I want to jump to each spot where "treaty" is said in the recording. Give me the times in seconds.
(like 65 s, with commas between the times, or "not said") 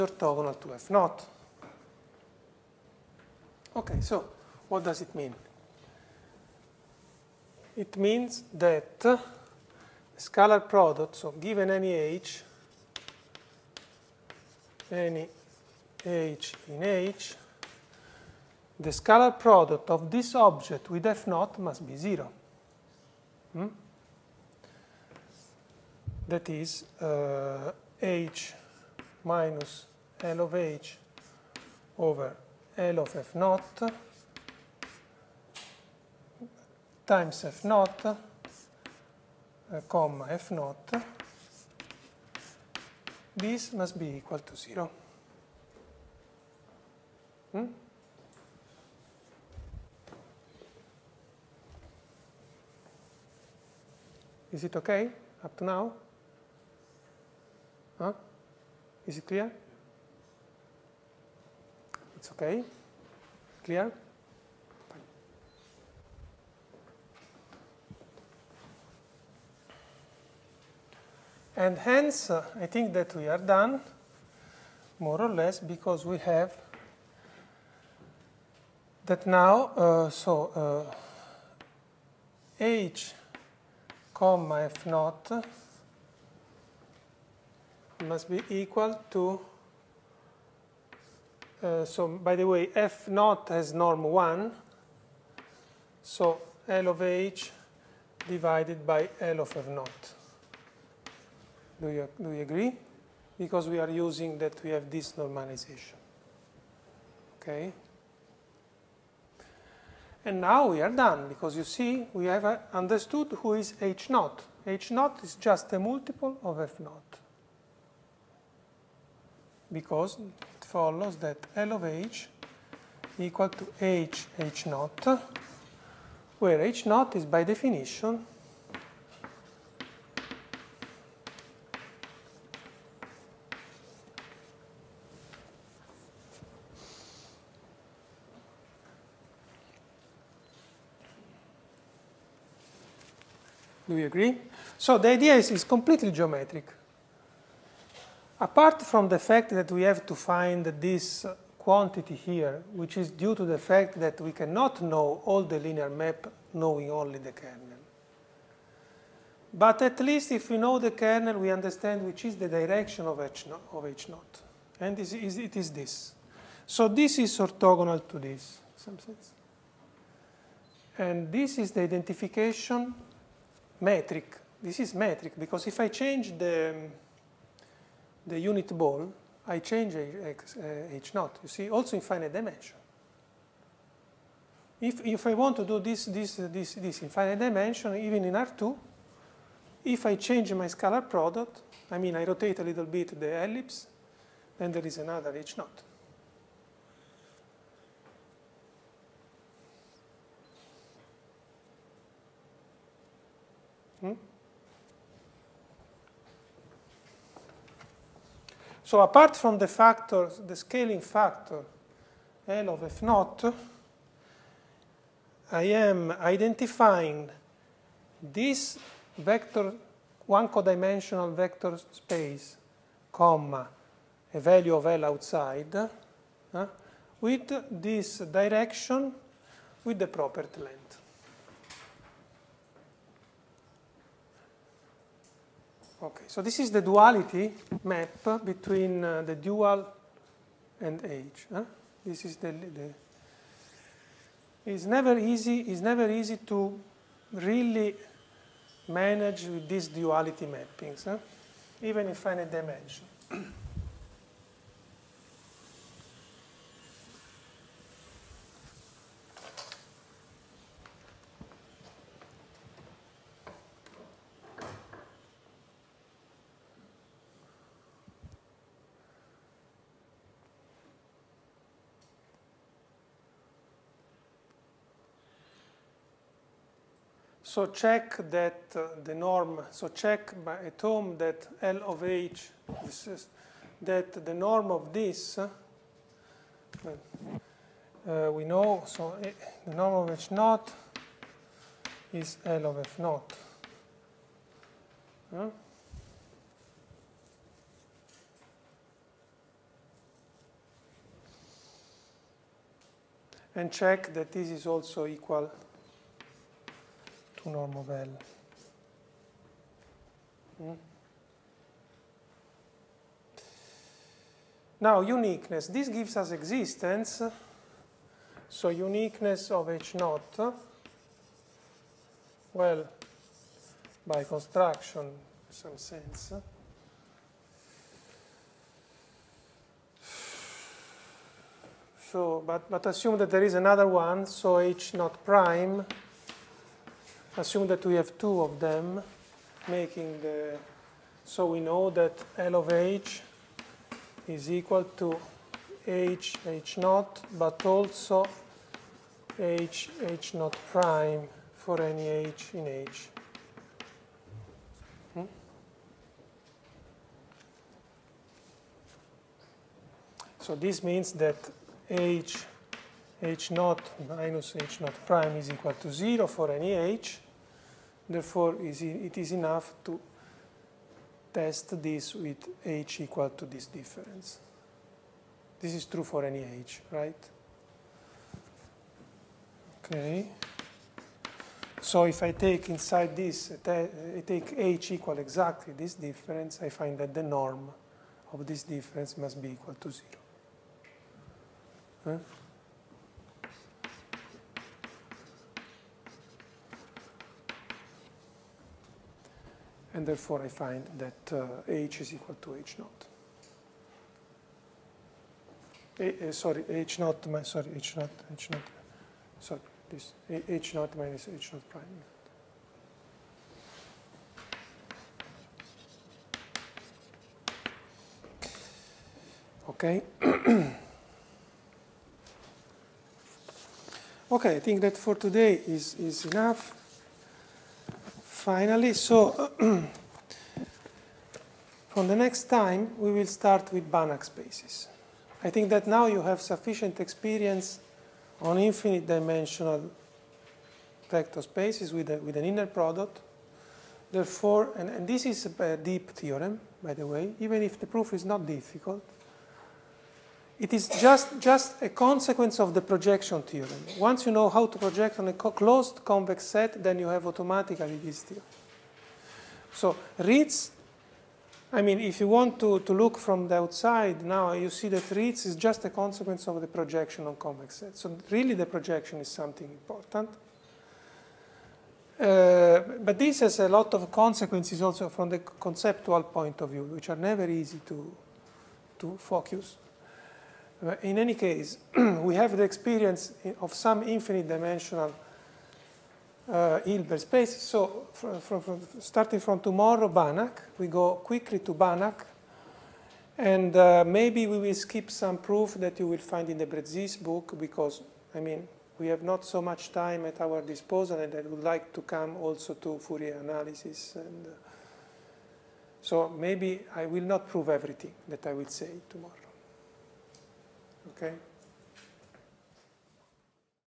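not said.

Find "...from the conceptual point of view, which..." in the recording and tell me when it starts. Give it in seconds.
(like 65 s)
475 s.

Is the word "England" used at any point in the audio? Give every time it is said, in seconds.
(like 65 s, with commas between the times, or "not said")
not said.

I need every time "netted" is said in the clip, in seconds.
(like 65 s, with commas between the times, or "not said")
not said.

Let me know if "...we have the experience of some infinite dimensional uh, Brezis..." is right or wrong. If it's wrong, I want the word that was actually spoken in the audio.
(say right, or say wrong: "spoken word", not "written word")
wrong: "Hilbert", not "Brezis".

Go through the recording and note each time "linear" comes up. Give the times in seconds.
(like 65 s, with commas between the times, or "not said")
155 s.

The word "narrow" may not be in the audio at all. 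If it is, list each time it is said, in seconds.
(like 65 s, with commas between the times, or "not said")
not said.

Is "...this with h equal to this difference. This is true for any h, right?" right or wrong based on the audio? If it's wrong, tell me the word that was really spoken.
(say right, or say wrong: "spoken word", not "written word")
right.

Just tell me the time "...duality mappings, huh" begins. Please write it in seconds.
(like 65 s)
249 s.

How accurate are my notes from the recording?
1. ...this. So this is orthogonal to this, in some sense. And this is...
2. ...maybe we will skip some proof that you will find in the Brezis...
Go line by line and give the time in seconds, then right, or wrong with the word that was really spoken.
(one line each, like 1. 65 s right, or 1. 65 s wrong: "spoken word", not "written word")
1. 165 s right
2. 494 s right.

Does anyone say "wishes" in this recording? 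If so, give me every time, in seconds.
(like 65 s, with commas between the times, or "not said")
not said.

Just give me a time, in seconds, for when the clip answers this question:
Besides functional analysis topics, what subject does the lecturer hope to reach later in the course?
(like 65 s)
502 s.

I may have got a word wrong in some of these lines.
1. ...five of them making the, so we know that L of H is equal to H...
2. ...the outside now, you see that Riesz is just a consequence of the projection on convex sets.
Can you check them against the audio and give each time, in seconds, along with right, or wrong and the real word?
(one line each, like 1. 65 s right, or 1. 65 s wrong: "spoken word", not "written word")
1. 338 s wrong: "two", not "five"
2. 463 s right.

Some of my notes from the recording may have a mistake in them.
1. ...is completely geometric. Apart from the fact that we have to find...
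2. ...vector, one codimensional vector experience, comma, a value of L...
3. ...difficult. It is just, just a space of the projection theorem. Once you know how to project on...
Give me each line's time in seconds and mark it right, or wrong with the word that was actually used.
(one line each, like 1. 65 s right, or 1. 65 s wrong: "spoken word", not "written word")
1. 145 s right
2. 219 s wrong: "space", not "experience"
3. 448 s wrong: "consequence", not "space".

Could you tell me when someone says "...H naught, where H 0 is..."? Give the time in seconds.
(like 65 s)
124 s.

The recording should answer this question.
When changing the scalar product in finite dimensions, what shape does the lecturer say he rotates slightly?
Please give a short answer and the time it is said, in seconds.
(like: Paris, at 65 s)
the ellipse, at 193 s.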